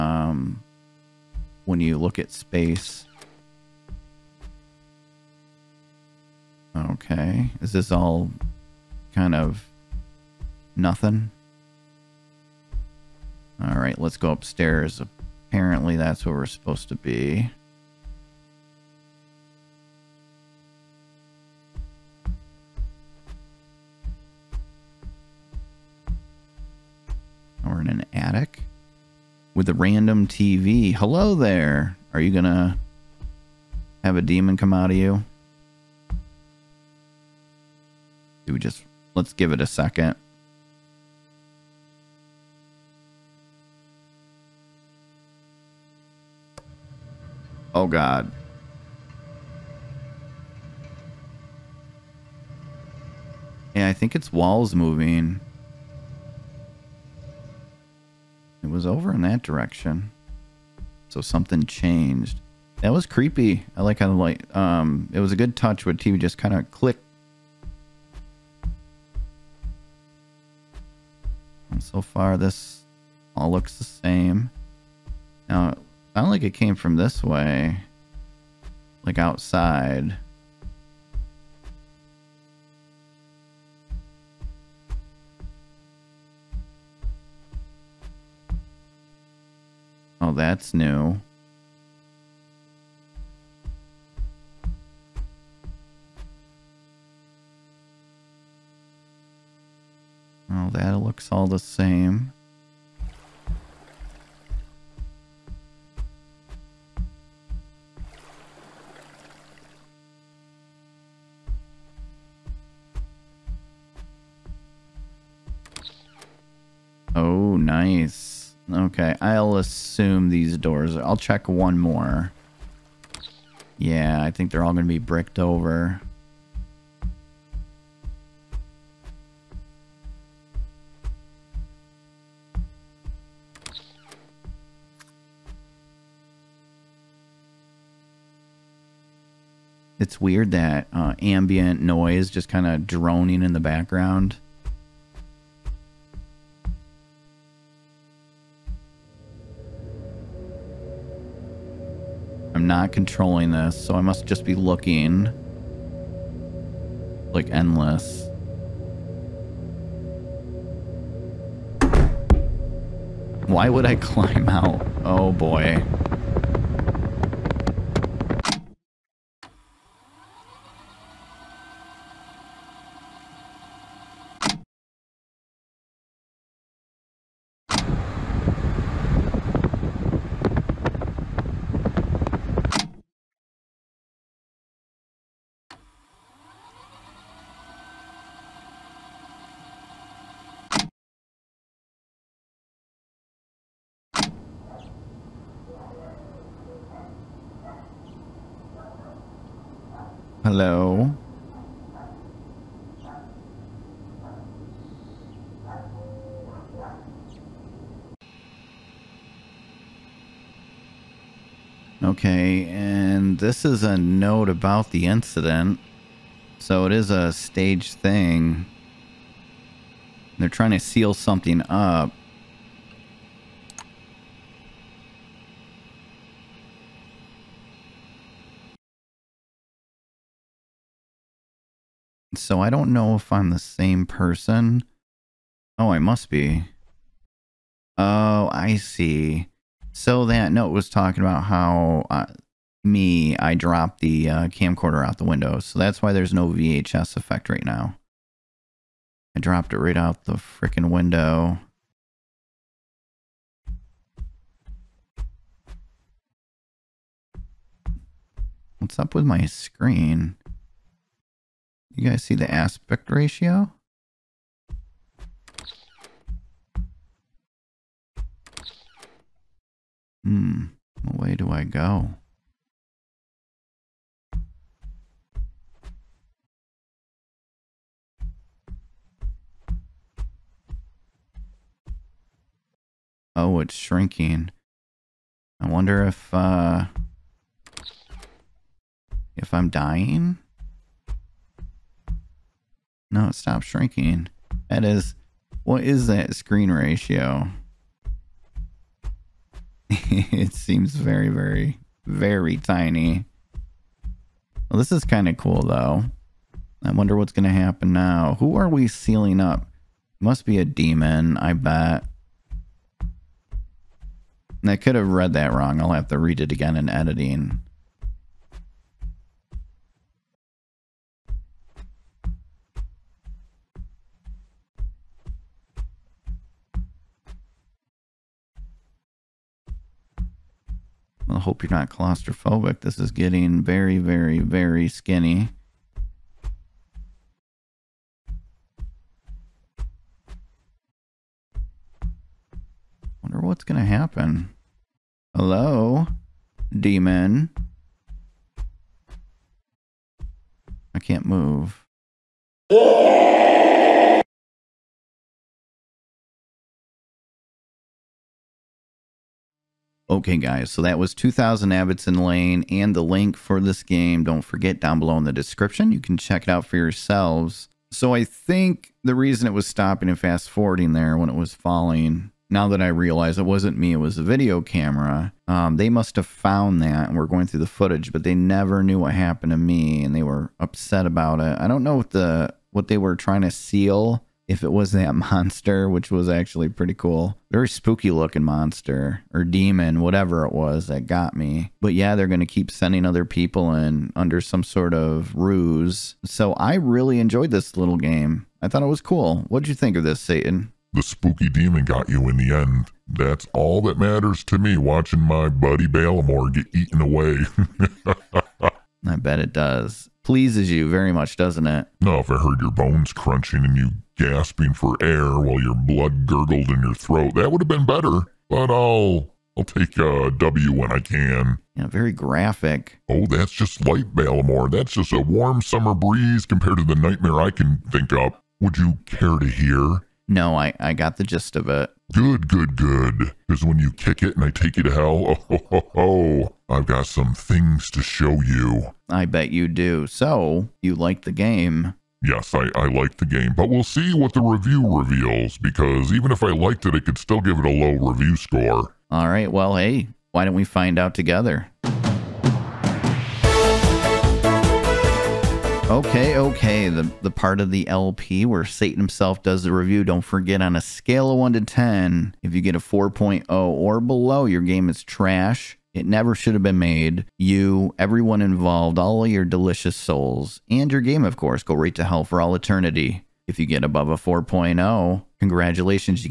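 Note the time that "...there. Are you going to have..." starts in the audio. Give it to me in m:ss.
0:31.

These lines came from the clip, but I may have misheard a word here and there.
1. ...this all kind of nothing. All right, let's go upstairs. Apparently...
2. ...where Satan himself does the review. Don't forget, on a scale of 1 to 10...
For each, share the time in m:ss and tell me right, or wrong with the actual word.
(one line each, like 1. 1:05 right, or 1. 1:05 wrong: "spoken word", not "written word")
1. 0:07 right
2. 7:38 right.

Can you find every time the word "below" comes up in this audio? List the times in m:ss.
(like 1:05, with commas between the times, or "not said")
6:04, 7:43.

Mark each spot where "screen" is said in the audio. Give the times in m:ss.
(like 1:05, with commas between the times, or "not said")
4:19, 4:56.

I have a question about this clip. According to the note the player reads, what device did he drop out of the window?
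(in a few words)
Camcorder.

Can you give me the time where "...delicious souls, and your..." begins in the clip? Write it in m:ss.
7:49.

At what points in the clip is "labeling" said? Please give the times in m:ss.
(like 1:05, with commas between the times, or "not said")
not said.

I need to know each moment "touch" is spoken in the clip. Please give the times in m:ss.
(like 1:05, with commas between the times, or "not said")
1:05.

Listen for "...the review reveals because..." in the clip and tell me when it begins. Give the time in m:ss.
7:24.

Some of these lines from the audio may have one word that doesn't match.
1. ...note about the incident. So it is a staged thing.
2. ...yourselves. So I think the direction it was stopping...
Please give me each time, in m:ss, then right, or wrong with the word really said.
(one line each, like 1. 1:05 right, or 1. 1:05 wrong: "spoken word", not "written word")
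1. 3:33 right
2. 6:06 wrong: "reason", not "direction".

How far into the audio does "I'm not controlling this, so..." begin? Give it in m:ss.
2:32.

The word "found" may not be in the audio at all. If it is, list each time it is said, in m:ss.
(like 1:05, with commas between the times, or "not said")
6:16.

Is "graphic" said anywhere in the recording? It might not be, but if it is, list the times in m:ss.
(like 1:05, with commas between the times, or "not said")
7:02.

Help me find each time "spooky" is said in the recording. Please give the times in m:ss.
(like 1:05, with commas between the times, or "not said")
6:27, 6:41.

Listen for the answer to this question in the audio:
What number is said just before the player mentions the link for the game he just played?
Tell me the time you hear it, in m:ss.
6:01.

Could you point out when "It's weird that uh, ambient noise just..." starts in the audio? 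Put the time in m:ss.
2:20.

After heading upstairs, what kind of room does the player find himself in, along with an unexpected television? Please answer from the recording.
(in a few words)
Attic.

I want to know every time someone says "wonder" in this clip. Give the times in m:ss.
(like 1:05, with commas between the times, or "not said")
4:45, 5:06, 5:43.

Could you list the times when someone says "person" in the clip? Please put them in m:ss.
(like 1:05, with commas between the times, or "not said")
3:54.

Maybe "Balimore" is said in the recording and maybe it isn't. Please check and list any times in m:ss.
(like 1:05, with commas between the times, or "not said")
6:45, 7:04.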